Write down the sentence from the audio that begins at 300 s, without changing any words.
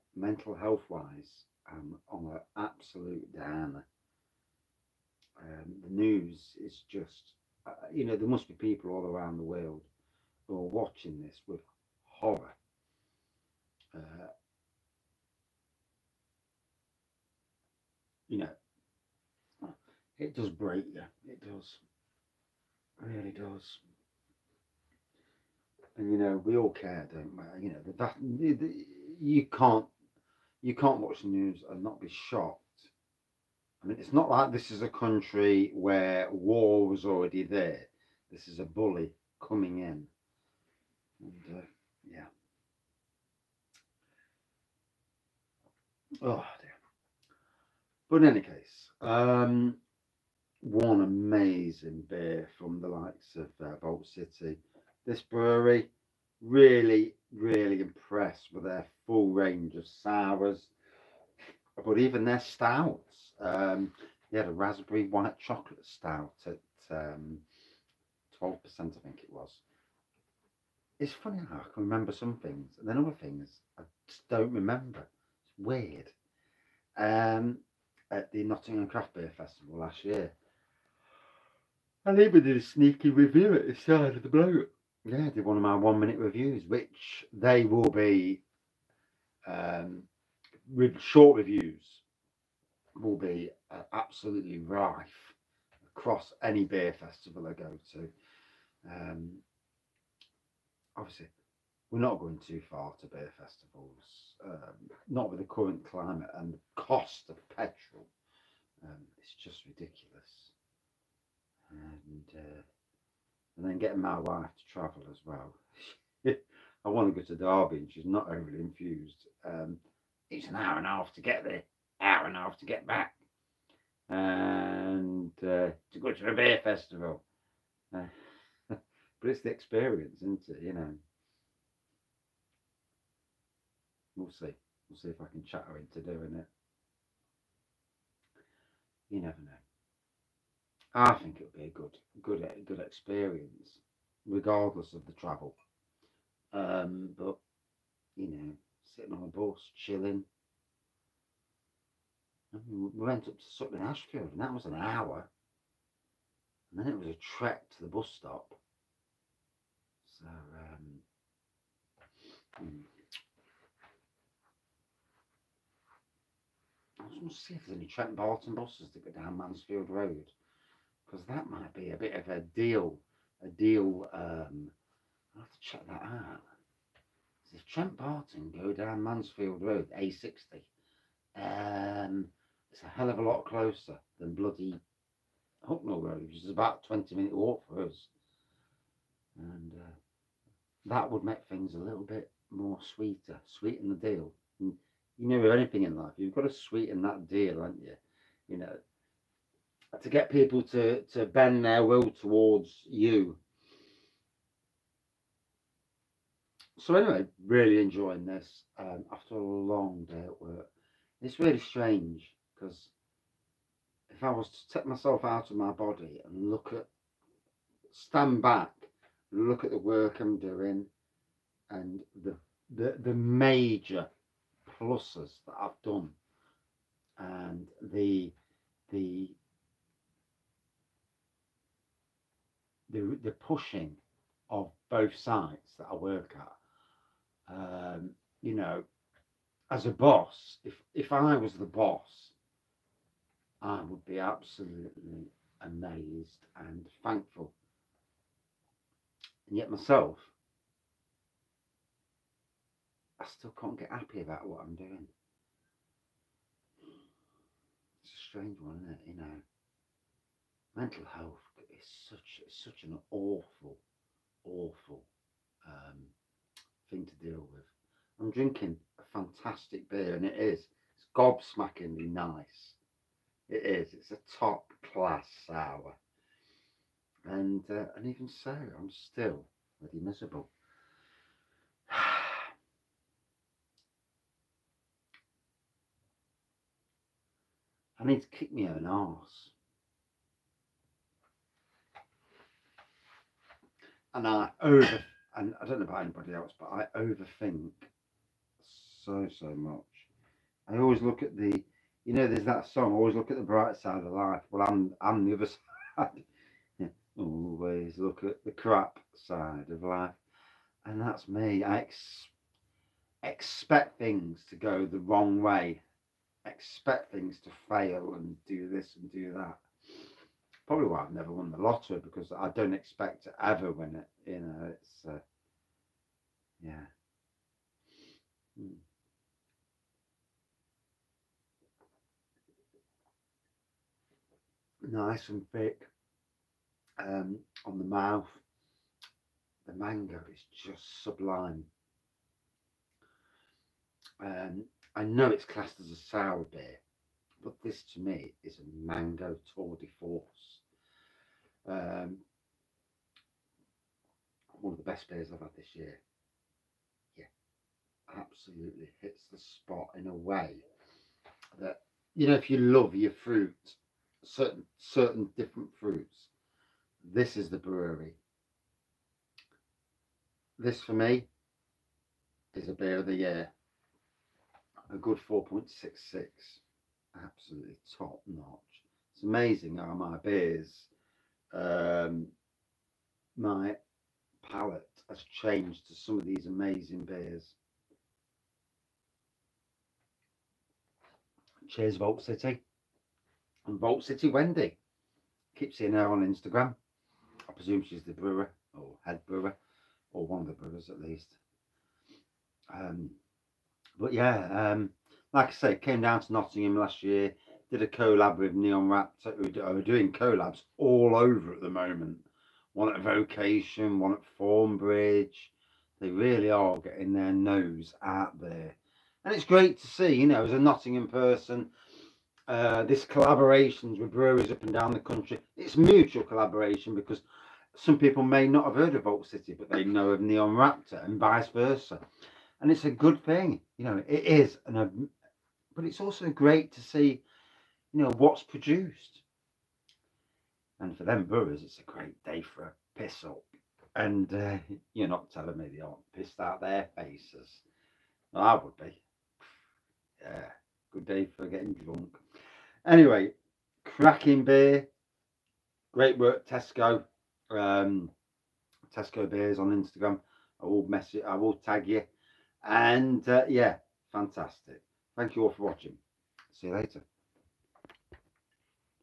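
I always look at the, you know, there's that song, always look at the bright side of life.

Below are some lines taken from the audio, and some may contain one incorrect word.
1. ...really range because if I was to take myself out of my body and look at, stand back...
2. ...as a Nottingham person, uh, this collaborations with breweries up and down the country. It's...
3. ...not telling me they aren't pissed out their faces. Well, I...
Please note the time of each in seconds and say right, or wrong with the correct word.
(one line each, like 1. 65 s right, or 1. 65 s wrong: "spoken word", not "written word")
1. 211 s wrong: "strange", not "range"
2. 420 s right
3. 445 s right.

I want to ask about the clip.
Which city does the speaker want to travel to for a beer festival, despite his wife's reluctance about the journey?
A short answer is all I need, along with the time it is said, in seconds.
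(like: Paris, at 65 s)
Derby, at 117 s.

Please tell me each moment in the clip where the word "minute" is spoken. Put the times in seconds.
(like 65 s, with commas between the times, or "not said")
85 s, 187 s.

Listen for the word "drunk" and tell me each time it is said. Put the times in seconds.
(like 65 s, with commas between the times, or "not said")
451 s.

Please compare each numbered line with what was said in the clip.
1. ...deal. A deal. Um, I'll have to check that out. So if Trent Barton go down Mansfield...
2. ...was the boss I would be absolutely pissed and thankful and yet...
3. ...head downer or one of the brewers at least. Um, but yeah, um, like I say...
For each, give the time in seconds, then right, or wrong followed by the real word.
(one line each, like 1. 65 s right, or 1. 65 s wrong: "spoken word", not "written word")
1. 172 s right
2. 241 s wrong: "amazed", not "pissed"
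3. 399 s wrong: "brewer", not "downer".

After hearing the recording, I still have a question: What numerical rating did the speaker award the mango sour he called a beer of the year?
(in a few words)
4.66.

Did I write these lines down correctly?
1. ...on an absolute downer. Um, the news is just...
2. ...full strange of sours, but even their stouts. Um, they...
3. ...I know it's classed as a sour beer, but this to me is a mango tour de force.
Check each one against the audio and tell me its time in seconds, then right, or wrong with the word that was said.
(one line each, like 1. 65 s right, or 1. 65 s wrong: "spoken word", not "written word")
1. 2 s right
2. 59 s wrong: "range", not "strange"
3. 344 s right.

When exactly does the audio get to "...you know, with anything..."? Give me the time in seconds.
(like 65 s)
195 s.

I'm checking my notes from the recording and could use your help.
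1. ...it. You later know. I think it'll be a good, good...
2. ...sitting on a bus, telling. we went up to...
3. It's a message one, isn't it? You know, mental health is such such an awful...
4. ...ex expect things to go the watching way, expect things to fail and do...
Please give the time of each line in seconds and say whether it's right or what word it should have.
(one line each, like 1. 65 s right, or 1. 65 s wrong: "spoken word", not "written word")
1. 136 s wrong: "never", not "later"
2. 148 s wrong: "chilling", not "telling"
3. 258 s wrong: "strange", not "message"
4. 311 s wrong: "wrong", not "watching".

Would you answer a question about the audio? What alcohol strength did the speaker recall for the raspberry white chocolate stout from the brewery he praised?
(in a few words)
12%.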